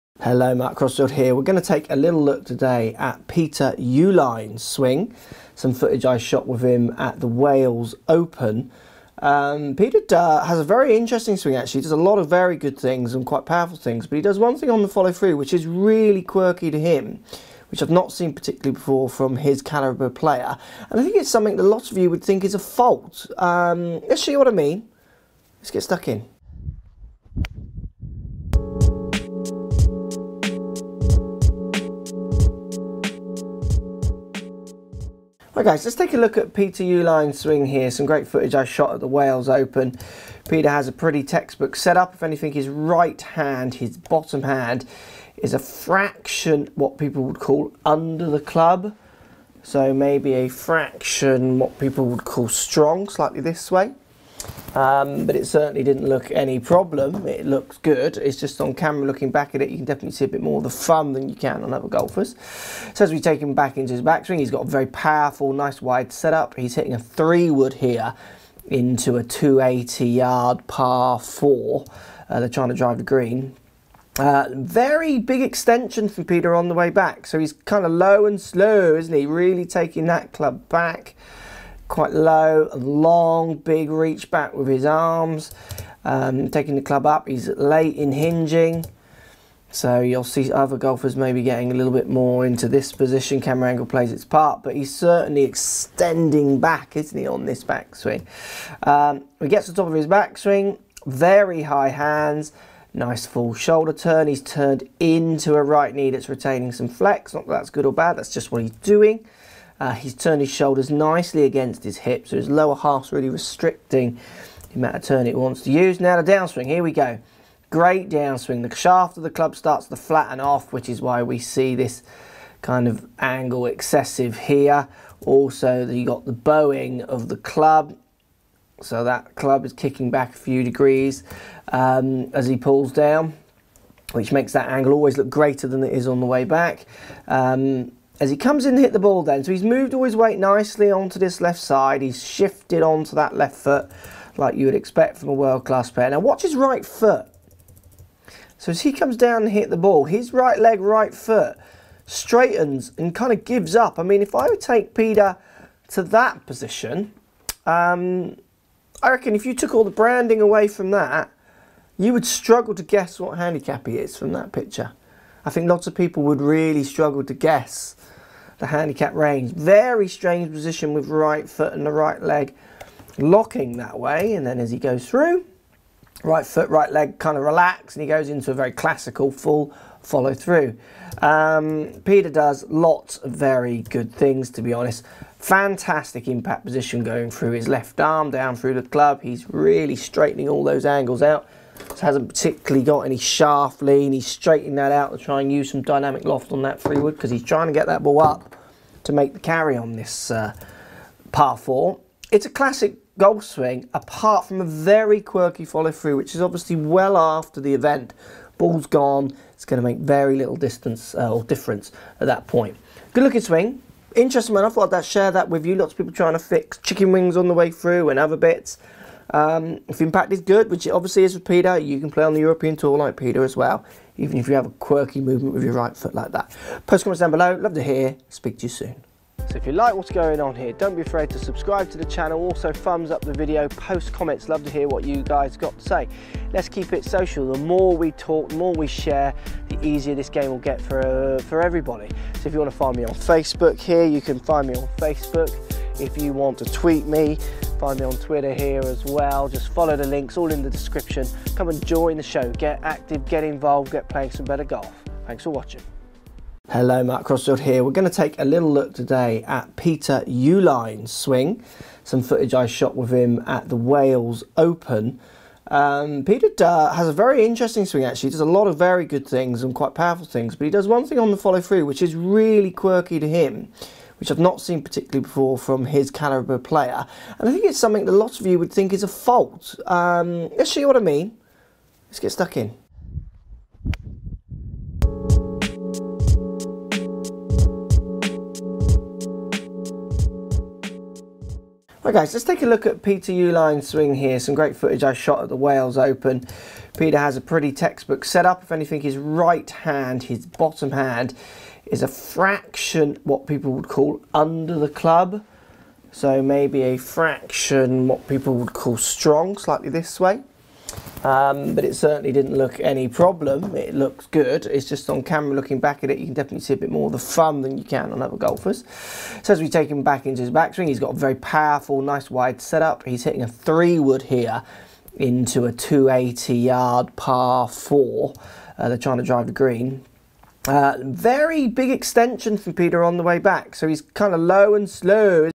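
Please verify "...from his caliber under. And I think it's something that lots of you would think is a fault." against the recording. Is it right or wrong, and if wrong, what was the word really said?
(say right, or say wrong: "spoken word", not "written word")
wrong: "player", not "under".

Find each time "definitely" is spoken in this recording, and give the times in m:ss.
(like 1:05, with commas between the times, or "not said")
0:59, 5:16.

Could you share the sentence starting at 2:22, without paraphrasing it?
He's shifted onto that left foot like you would expect from a world-class player.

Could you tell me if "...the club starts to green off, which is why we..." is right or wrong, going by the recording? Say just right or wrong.
wrong.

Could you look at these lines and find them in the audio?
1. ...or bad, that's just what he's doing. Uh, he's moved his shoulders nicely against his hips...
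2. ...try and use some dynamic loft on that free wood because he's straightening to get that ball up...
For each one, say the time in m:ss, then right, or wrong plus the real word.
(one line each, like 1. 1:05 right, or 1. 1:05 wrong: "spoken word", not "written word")
1. 1:47 wrong: "turned", not "moved"
2. 3:15 wrong: "trying", not "straightening".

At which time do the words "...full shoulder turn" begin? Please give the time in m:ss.
1:43.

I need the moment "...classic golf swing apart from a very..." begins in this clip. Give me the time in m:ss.
3:22.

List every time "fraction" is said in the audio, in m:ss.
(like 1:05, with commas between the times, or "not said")
0:45, 0:50, 5:02, 5:06.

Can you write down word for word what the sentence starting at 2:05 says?
Also, you got the bowing of the club.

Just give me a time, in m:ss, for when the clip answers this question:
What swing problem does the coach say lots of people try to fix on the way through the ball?
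3:36.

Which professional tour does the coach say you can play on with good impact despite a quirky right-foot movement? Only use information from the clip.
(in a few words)
European Tour.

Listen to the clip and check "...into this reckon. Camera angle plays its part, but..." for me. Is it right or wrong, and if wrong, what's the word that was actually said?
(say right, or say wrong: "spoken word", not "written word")
wrong: "position", not "reckon".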